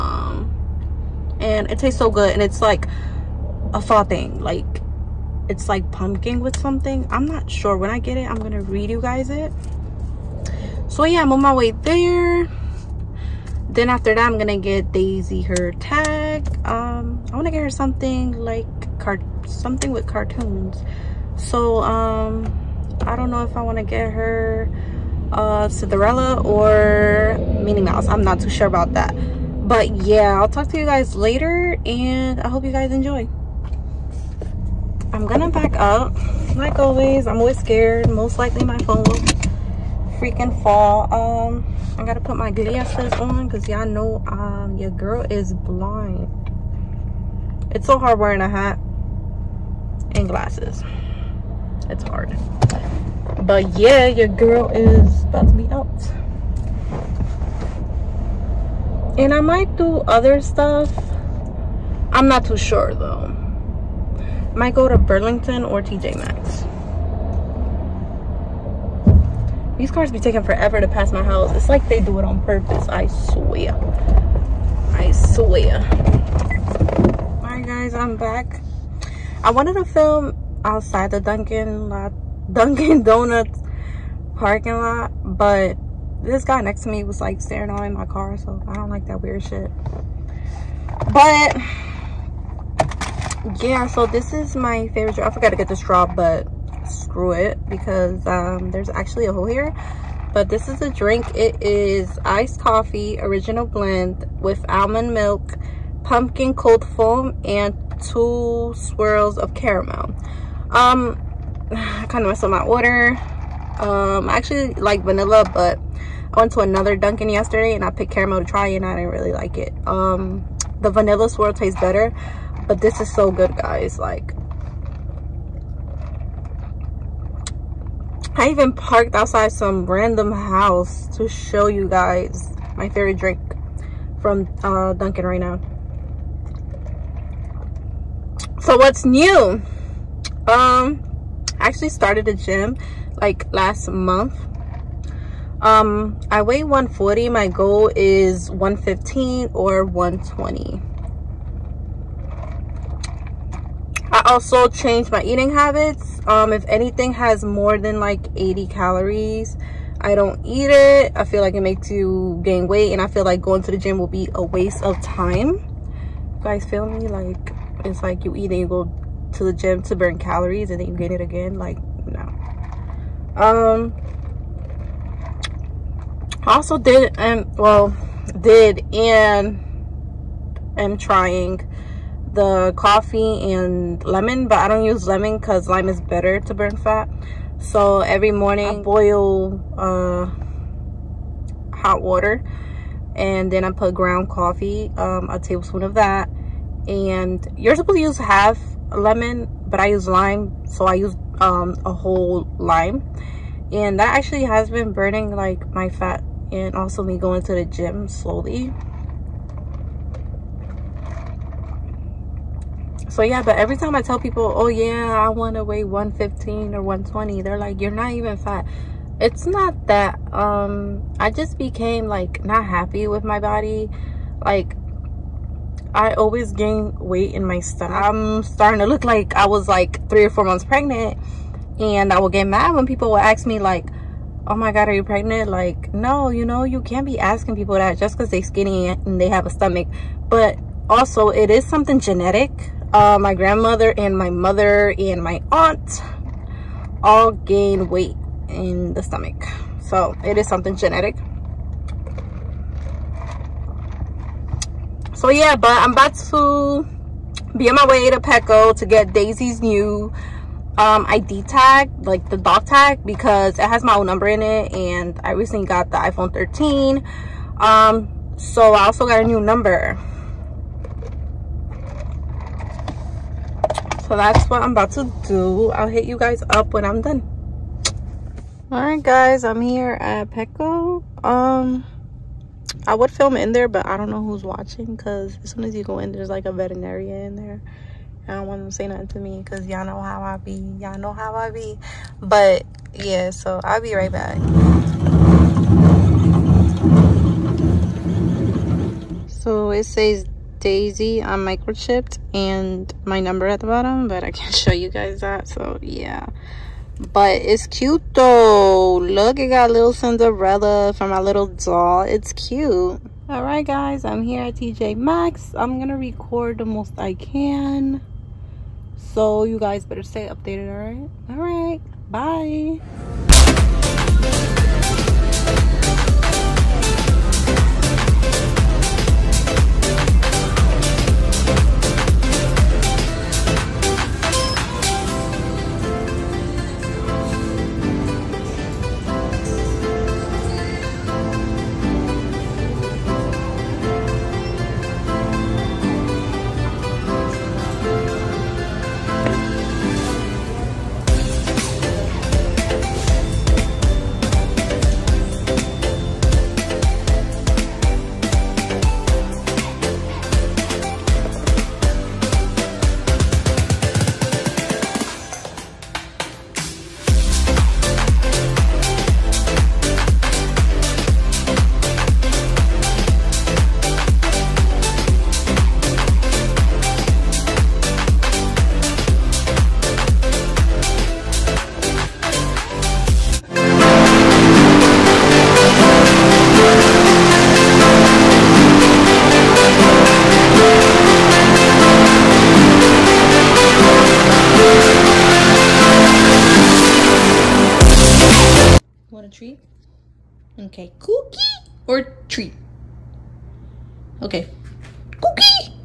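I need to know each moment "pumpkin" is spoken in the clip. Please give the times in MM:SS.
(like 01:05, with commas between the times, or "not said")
00:05, 01:46.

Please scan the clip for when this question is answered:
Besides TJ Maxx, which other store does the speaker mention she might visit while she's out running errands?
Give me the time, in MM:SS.
01:04.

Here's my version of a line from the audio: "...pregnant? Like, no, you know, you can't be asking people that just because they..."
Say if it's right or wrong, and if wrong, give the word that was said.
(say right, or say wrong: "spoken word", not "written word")
right.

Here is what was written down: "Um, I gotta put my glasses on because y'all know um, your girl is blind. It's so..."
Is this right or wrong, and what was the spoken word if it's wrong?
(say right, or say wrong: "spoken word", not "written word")
right.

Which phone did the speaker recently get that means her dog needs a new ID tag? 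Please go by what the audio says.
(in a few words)
iPhone 13.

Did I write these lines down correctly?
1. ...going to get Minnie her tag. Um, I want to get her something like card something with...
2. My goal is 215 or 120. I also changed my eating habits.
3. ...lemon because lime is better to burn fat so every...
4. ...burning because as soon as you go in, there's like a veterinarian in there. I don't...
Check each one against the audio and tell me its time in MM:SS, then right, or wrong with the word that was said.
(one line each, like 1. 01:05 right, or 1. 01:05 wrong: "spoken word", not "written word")
1. 00:14 wrong: "Daisy", not "Minnie"
2. 02:27 wrong: "115", not "215"
3. 03:05 right
4. 04:44 wrong: "watching", not "burning".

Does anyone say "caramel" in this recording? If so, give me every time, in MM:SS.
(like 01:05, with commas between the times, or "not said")
01:49, 01:58.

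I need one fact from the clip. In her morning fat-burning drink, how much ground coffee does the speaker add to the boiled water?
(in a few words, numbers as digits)
A tablespoon.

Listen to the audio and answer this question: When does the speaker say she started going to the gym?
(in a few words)
Last month.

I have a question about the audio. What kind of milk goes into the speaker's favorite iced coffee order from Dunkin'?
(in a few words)
Almond milk.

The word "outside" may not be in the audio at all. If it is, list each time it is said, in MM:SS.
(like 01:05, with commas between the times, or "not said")
01:20, 02:09.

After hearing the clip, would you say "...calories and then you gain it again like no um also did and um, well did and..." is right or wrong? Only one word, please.
right.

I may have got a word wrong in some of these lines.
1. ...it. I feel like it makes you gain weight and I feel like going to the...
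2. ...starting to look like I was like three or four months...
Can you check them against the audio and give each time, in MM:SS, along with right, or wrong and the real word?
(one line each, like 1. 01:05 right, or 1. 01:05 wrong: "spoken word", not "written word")
1. 02:40 right
2. 03:48 right.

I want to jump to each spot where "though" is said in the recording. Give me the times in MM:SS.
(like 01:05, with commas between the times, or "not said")
01:02, 05:08.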